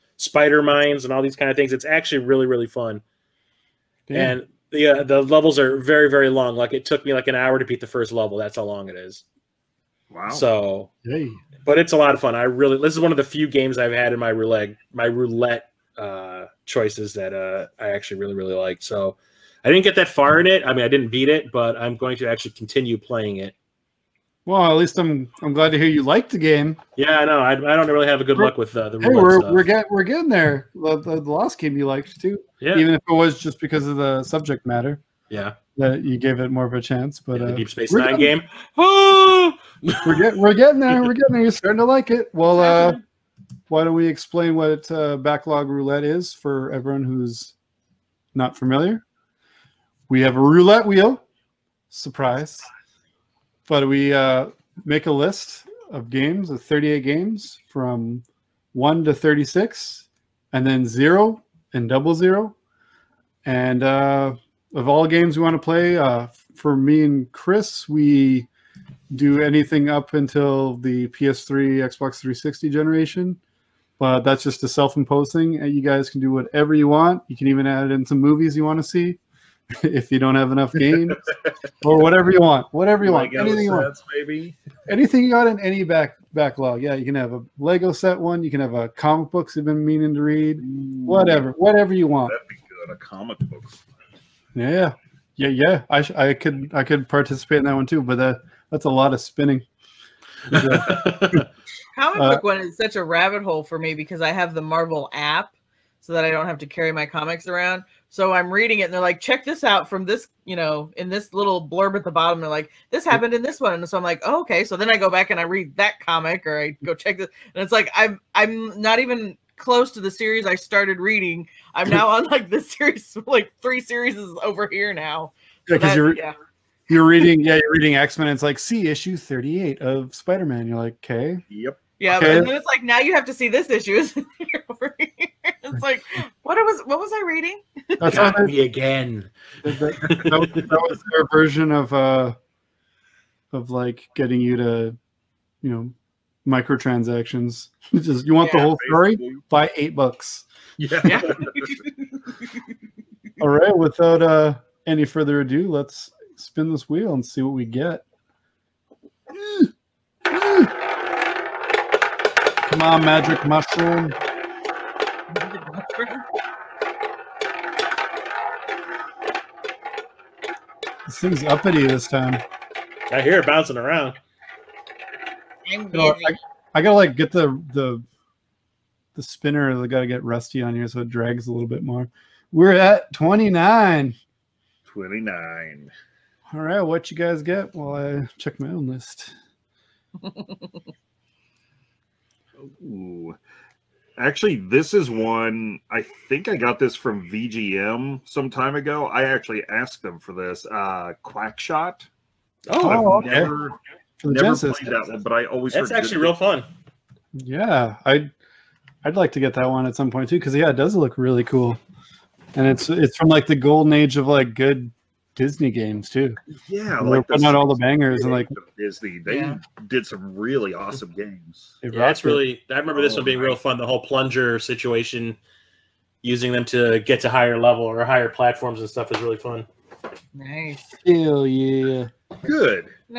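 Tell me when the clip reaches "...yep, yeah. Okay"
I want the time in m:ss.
2:11.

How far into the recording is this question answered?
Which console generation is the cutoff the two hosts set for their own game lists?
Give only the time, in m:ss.
1:11.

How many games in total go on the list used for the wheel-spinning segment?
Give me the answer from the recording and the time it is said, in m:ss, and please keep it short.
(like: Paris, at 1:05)
38, at 0:56.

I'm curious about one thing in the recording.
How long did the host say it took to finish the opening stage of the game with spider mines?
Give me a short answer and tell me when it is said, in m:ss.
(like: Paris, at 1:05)
an hour, at 0:07.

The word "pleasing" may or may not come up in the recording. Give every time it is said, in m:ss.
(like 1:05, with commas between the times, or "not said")
not said.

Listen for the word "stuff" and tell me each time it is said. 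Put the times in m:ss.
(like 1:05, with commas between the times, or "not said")
0:29, 3:48.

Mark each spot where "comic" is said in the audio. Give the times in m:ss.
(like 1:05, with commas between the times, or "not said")
1:28, 1:32, 1:40, 1:47, 1:56.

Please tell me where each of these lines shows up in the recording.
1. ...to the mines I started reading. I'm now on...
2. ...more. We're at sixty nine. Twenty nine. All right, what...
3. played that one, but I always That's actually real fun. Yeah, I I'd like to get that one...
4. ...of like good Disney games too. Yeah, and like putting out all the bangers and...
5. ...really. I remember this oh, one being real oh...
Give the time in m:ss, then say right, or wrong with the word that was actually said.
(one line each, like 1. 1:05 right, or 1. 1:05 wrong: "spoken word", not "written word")
1. 1:59 wrong: "series", not "mines"
2. 3:01 wrong: "twenty", not "sixty"
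3. 3:24 right
4. 3:34 right
5. 3:42 right.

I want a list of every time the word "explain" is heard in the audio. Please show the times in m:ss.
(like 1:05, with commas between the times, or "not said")
0:44.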